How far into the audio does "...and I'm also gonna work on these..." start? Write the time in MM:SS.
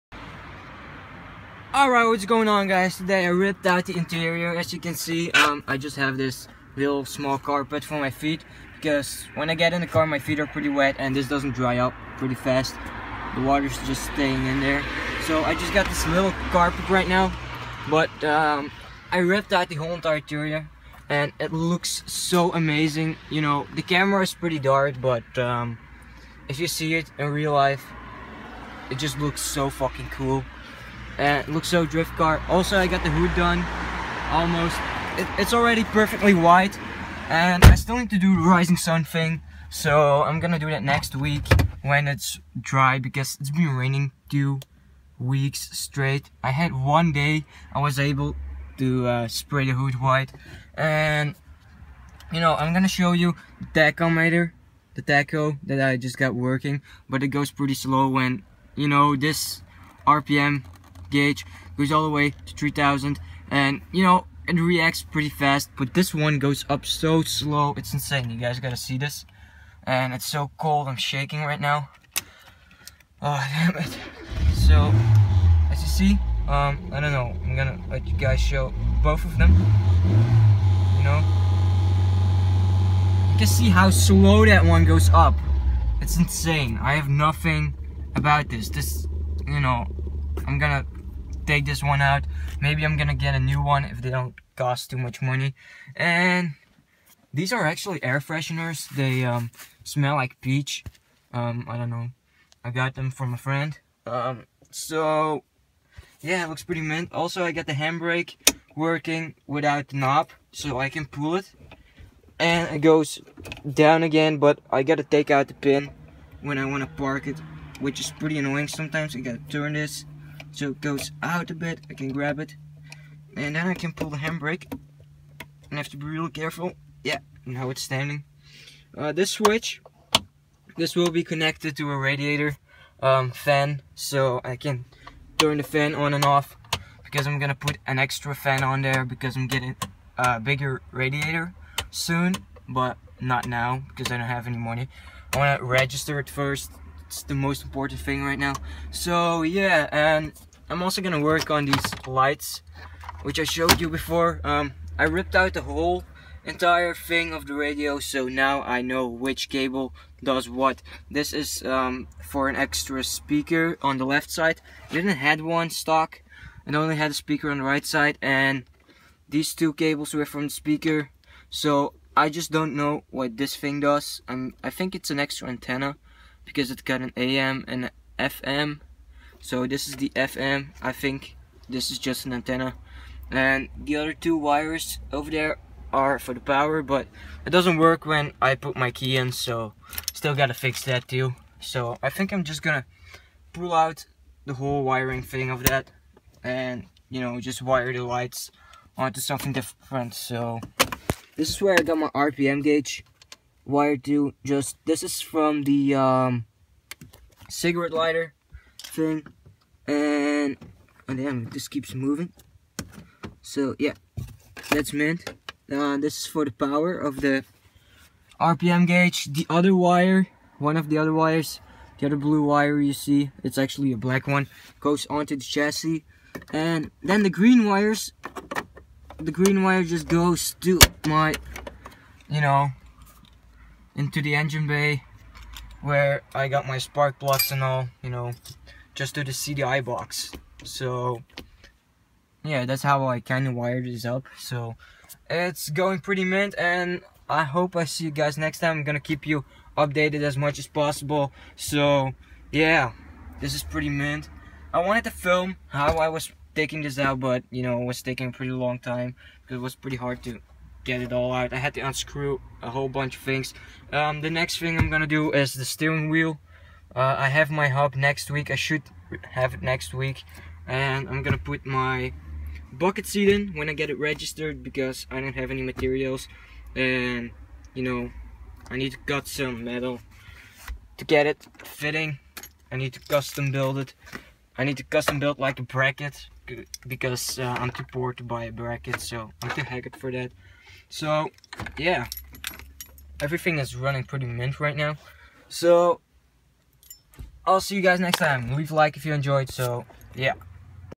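02:29.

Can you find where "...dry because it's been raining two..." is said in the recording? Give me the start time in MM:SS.
00:42.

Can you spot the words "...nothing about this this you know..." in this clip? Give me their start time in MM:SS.
01:27.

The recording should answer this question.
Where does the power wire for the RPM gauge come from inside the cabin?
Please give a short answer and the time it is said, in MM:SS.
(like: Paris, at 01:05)
Cigarette lighter, at 03:27.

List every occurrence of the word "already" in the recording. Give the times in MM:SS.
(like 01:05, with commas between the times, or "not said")
00:35.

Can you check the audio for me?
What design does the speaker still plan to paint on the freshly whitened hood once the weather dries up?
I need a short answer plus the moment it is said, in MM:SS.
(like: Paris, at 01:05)
Rising Sun, at 00:38.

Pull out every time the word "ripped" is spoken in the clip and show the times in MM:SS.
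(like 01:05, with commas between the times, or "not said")
00:03, 00:19, 02:35.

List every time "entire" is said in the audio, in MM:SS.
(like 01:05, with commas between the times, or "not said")
00:19, 02:36.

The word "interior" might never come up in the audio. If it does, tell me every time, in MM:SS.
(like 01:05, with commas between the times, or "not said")
00:03, 00:20.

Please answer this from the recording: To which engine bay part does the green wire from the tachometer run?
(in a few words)
CDI box.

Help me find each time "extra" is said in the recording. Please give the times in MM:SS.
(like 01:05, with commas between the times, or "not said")
02:17, 02:42, 02:55.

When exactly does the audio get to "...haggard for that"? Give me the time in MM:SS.
04:49.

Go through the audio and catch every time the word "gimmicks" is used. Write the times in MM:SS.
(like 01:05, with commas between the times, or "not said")
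not said.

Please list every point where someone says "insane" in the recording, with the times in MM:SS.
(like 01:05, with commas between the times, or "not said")
01:07, 01:26.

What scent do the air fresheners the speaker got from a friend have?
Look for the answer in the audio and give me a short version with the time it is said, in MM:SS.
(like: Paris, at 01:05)
Peach, at 01:40.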